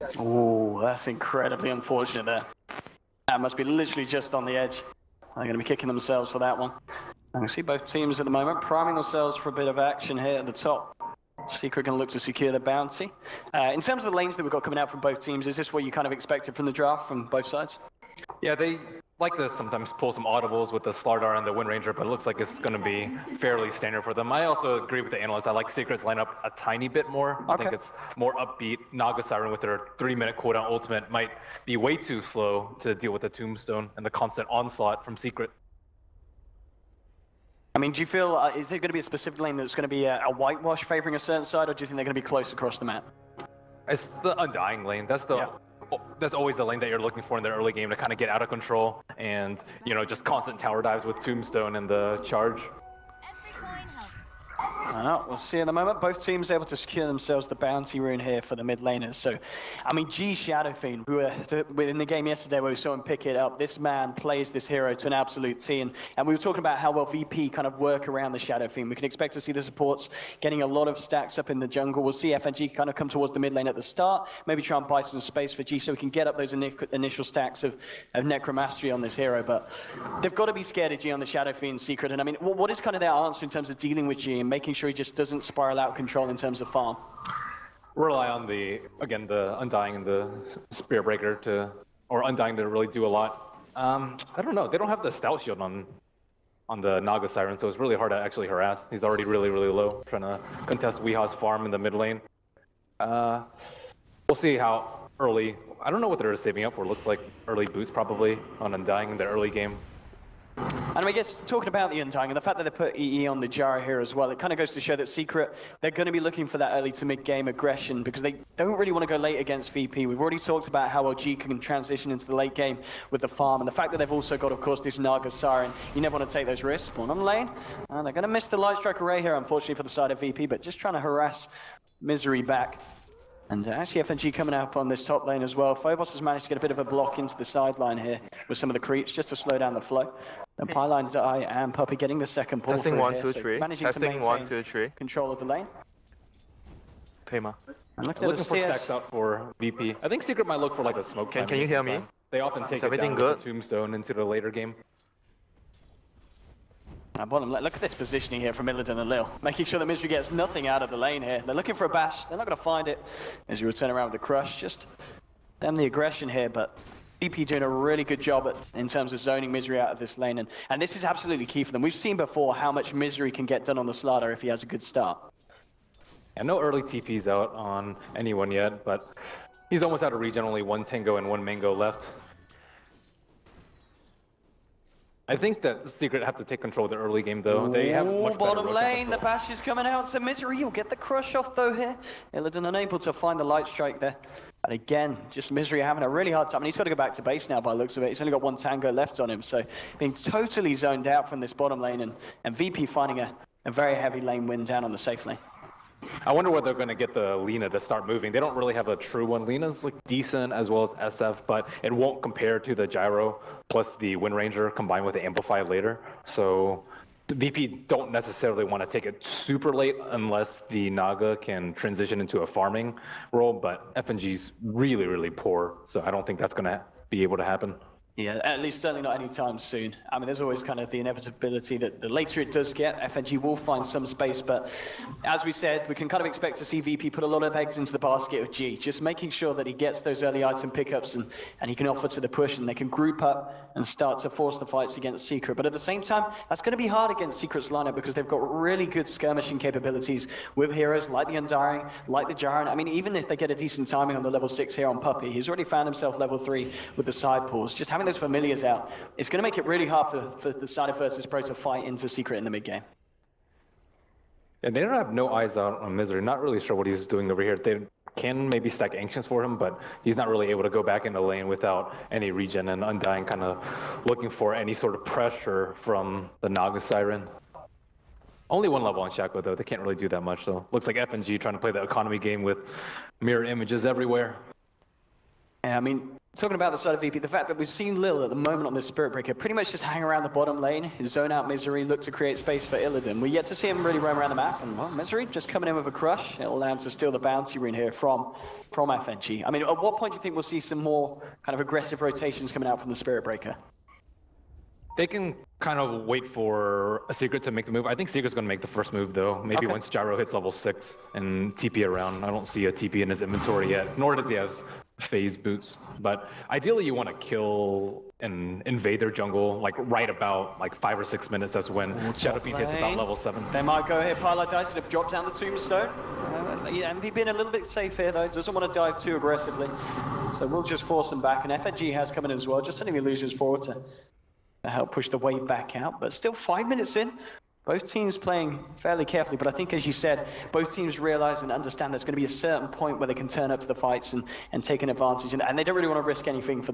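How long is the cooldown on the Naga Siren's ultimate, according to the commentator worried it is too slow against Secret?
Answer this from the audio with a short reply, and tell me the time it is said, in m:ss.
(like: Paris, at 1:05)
3 minutes, at 0:29.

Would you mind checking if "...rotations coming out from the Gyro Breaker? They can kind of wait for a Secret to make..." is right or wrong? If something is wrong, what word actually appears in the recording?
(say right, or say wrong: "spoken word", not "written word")
wrong: "Spirit", not "Gyro".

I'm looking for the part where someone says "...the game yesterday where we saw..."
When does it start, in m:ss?
1:01.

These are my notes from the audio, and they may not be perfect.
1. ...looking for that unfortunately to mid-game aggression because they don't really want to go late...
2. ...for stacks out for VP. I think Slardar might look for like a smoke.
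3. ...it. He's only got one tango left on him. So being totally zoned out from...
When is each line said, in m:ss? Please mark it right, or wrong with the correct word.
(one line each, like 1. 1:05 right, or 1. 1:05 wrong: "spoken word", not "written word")
1. 1:56 wrong: "early", not "unfortunately"
2. 2:28 wrong: "Secret", not "Slardar"
3. 3:18 right.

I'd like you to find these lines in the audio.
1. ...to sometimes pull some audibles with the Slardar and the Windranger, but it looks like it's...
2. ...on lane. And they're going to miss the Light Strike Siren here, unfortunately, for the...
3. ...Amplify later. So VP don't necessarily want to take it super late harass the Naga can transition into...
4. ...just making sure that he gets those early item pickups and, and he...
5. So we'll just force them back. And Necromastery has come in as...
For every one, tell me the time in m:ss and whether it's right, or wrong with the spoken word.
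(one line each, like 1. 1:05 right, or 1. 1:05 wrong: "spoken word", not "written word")
1. 0:19 right
2. 2:07 wrong: "Array", not "Siren"
3. 3:35 wrong: "unless", not "harass"
4. 3:58 right
5. 5:30 wrong: "FNG", not "Necromastery".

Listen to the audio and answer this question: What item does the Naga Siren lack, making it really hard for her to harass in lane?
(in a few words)
Stout Shield.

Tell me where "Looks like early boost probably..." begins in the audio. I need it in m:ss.
1:46.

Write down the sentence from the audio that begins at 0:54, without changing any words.
Well, uh, we'll see in a moment.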